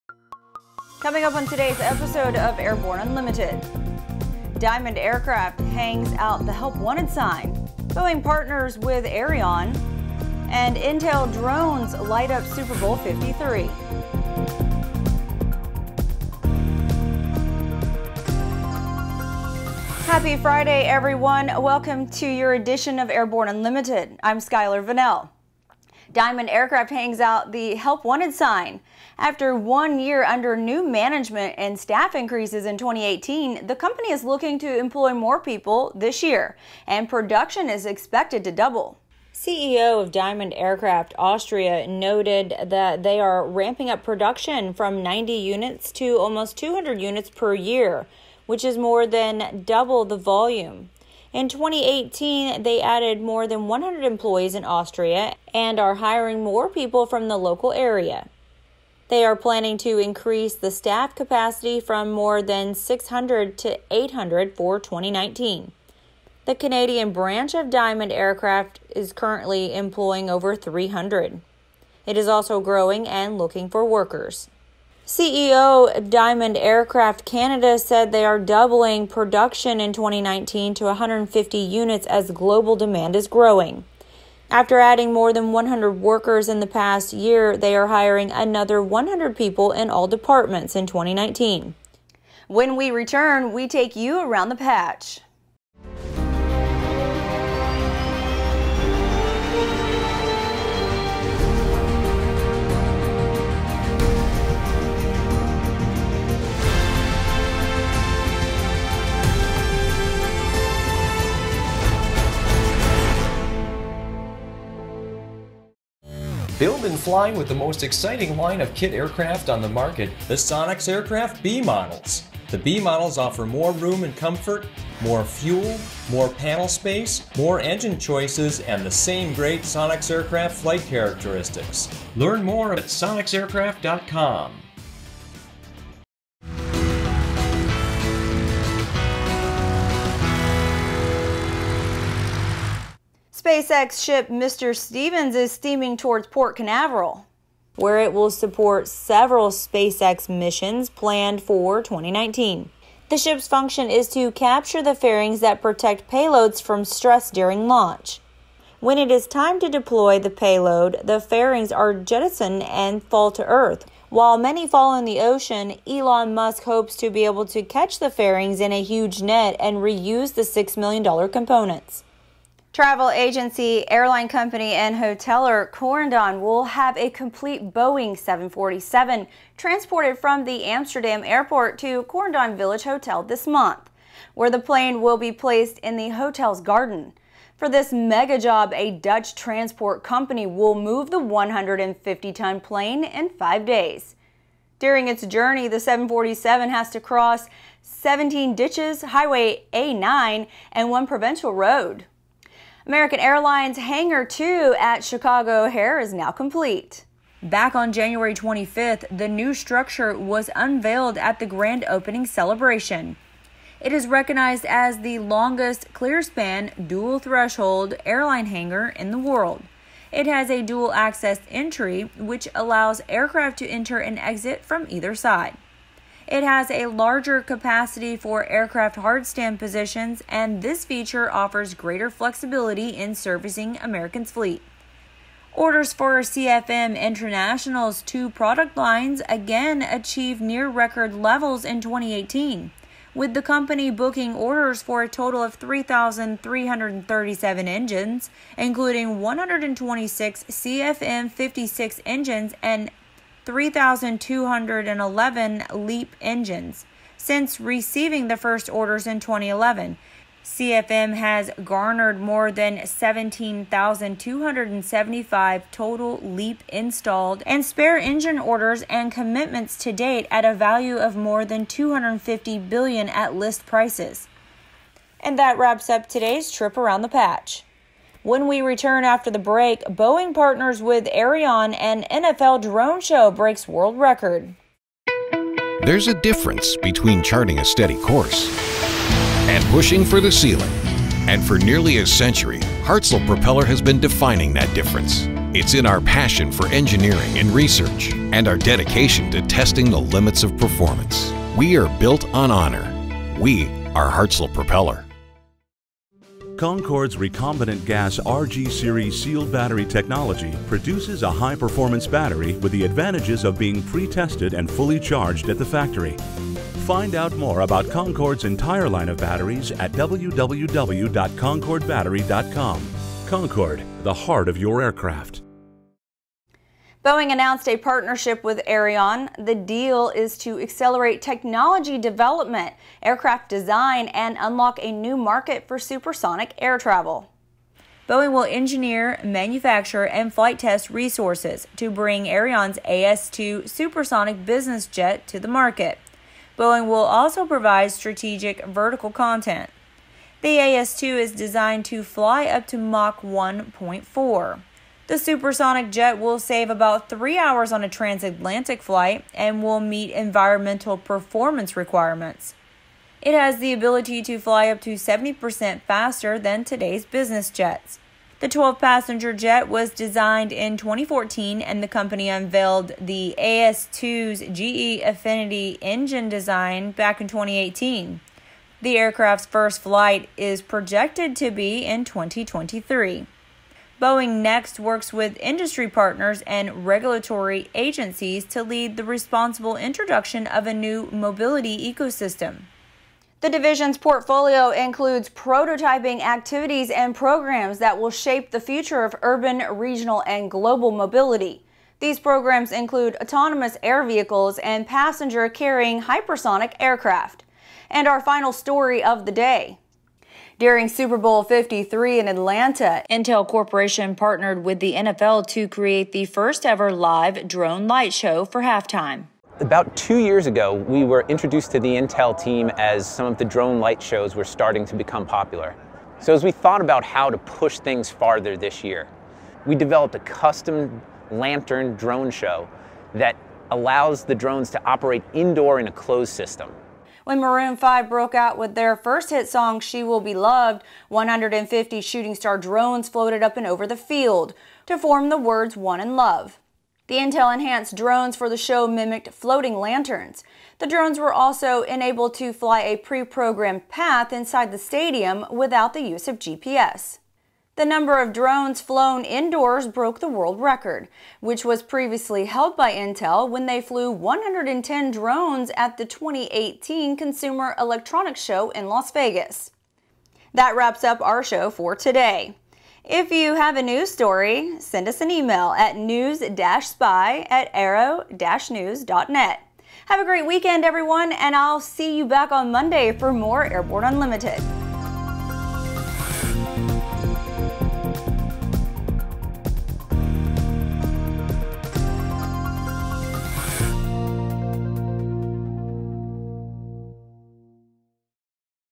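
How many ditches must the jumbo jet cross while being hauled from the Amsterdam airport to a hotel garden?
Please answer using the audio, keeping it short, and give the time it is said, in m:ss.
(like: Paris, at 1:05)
17, at 3:17.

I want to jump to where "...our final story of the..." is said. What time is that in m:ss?
6:48.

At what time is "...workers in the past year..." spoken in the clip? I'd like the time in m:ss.
1:25.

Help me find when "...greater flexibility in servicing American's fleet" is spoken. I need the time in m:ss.
3:51.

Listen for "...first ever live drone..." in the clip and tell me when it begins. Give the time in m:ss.
6:56.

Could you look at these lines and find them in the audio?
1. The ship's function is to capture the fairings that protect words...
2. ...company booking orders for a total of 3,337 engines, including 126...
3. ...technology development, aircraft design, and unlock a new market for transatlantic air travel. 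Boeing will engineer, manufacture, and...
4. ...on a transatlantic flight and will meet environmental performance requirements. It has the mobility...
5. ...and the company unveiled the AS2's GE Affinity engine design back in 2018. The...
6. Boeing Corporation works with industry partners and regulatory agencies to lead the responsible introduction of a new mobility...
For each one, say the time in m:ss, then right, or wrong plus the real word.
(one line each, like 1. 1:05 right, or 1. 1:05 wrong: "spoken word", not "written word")
1. 2:33 wrong: "payloads", not "words"
2. 4:03 right
3. 5:31 wrong: "supersonic", not "transatlantic"
4. 5:57 wrong: "ability", not "mobility"
5. 6:11 right
6. 6:24 wrong: "Next", not "Corporation".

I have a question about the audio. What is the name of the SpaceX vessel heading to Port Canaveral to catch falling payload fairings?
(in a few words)
Mr. Stevens.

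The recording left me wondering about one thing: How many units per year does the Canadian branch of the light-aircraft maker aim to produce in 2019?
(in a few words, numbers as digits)
150.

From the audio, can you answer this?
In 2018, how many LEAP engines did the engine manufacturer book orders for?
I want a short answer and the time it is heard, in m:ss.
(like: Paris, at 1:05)
3,211, at 4:13.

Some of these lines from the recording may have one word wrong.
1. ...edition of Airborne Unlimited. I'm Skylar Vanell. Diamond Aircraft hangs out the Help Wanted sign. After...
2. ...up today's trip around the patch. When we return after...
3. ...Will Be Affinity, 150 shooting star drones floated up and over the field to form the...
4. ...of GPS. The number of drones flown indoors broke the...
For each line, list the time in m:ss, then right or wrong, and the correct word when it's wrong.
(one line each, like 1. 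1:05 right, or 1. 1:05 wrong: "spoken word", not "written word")
1. 0:22 right
2. 4:35 right
3. 7:20 wrong: "Loved", not "Affinity"
4. 7:36 right.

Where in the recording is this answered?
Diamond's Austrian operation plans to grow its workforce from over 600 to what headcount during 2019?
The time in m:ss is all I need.
1:03.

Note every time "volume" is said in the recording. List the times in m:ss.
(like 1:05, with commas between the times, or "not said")
0:50.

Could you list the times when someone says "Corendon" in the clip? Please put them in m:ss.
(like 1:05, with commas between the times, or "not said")
2:55, 3:02.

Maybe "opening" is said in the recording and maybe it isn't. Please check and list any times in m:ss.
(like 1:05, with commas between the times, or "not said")
3:31.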